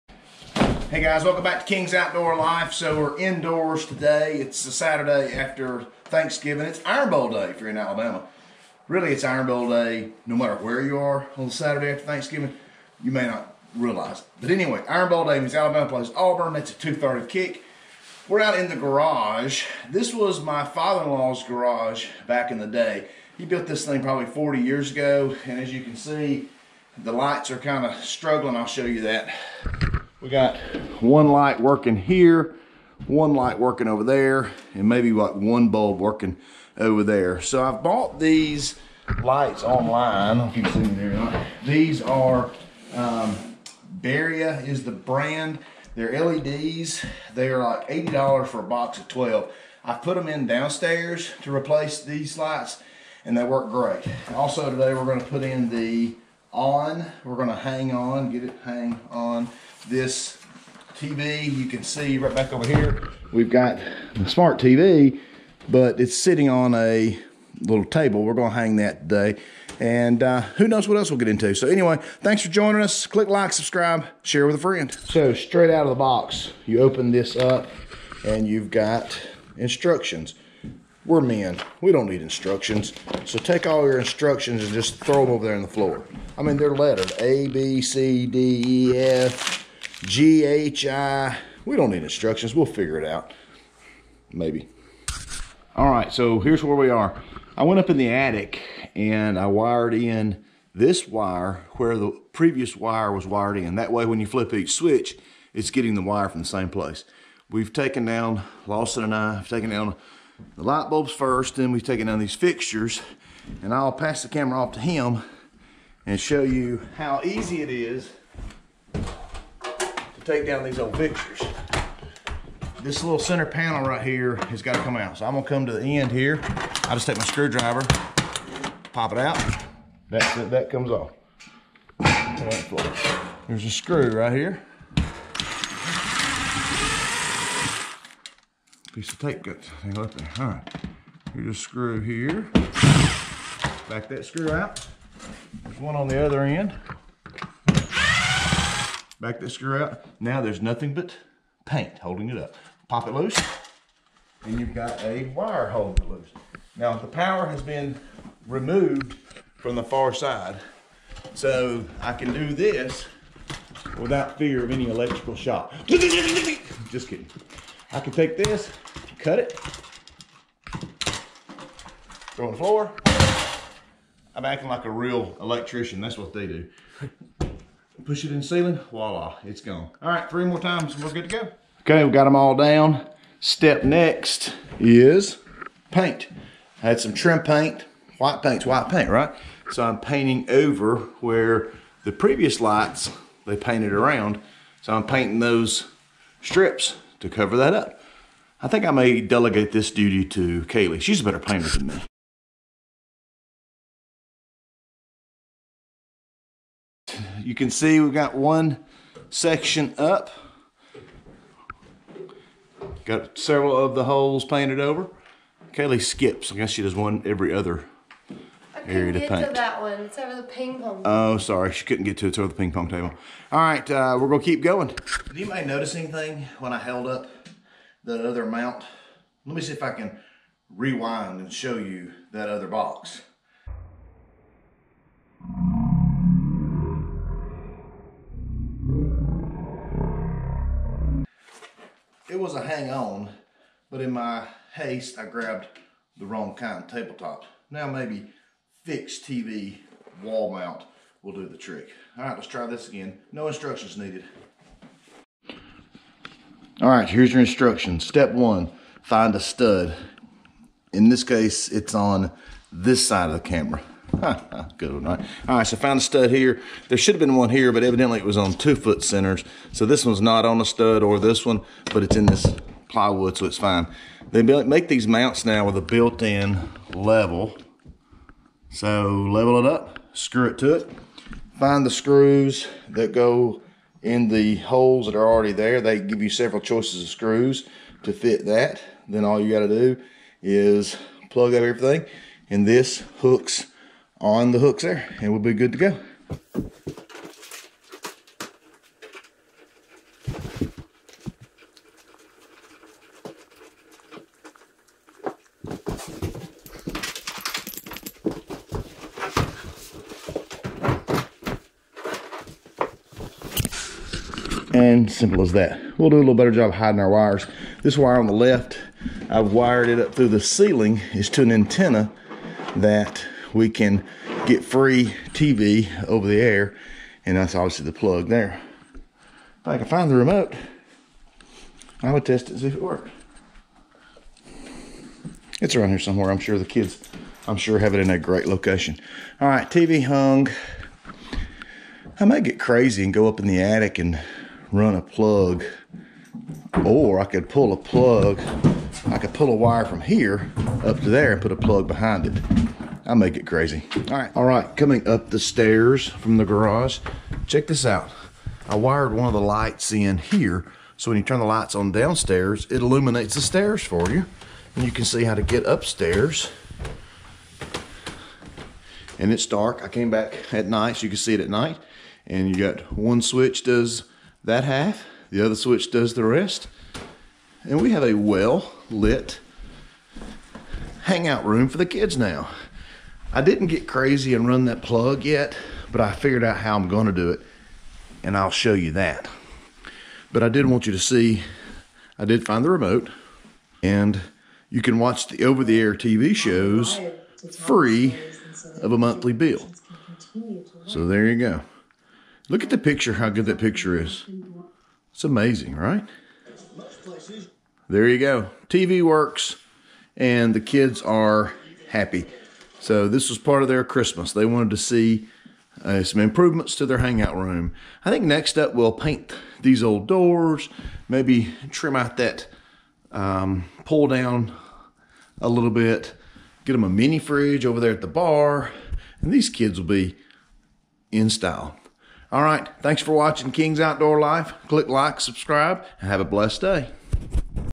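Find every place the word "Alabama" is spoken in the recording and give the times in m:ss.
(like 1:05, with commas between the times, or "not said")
0:07, 0:15.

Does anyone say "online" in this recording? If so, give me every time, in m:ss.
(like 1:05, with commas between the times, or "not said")
0:39.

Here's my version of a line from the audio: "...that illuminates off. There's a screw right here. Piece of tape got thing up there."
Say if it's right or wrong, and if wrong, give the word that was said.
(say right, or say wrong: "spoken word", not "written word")
wrong: "comes", not "illuminates".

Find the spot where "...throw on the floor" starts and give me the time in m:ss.
2:52.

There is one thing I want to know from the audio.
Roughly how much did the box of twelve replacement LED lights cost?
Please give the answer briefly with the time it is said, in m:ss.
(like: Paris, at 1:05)
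$80, at 0:47.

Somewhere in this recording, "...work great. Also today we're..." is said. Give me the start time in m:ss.
0:53.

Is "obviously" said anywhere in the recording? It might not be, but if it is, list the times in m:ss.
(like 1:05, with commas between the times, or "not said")
5:27.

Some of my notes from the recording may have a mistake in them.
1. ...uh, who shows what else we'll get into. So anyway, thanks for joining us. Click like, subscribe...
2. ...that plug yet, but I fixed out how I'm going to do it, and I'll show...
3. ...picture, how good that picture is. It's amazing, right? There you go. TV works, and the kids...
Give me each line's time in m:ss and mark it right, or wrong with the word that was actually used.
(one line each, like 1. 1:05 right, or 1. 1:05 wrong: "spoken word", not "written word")
1. 1:10 wrong: "knows", not "shows"
2. 6:24 wrong: "figured", not "fixed"
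3. 6:42 right.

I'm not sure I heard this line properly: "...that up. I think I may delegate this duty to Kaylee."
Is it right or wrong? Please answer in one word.
right.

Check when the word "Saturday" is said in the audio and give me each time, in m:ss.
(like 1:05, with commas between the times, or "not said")
0:04, 0:11.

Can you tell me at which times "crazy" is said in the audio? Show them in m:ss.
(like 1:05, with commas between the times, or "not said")
5:42, 5:53, 6:23.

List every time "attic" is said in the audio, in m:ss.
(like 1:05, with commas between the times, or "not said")
1:38, 5:43.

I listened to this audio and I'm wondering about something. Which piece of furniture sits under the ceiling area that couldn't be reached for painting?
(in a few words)
Ping pong table.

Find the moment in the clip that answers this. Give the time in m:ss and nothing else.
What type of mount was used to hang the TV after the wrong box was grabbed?
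4:08.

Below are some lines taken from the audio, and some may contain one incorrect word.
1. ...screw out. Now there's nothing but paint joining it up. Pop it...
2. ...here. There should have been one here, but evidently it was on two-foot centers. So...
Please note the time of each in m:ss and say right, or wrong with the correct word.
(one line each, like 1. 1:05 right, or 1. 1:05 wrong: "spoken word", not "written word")
1. 2:29 wrong: "holding", not "joining"
2. 4:26 right.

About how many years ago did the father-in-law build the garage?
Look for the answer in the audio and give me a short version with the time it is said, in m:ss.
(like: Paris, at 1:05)
40 years, at 0:24.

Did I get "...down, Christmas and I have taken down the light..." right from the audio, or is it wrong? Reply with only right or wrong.
wrong.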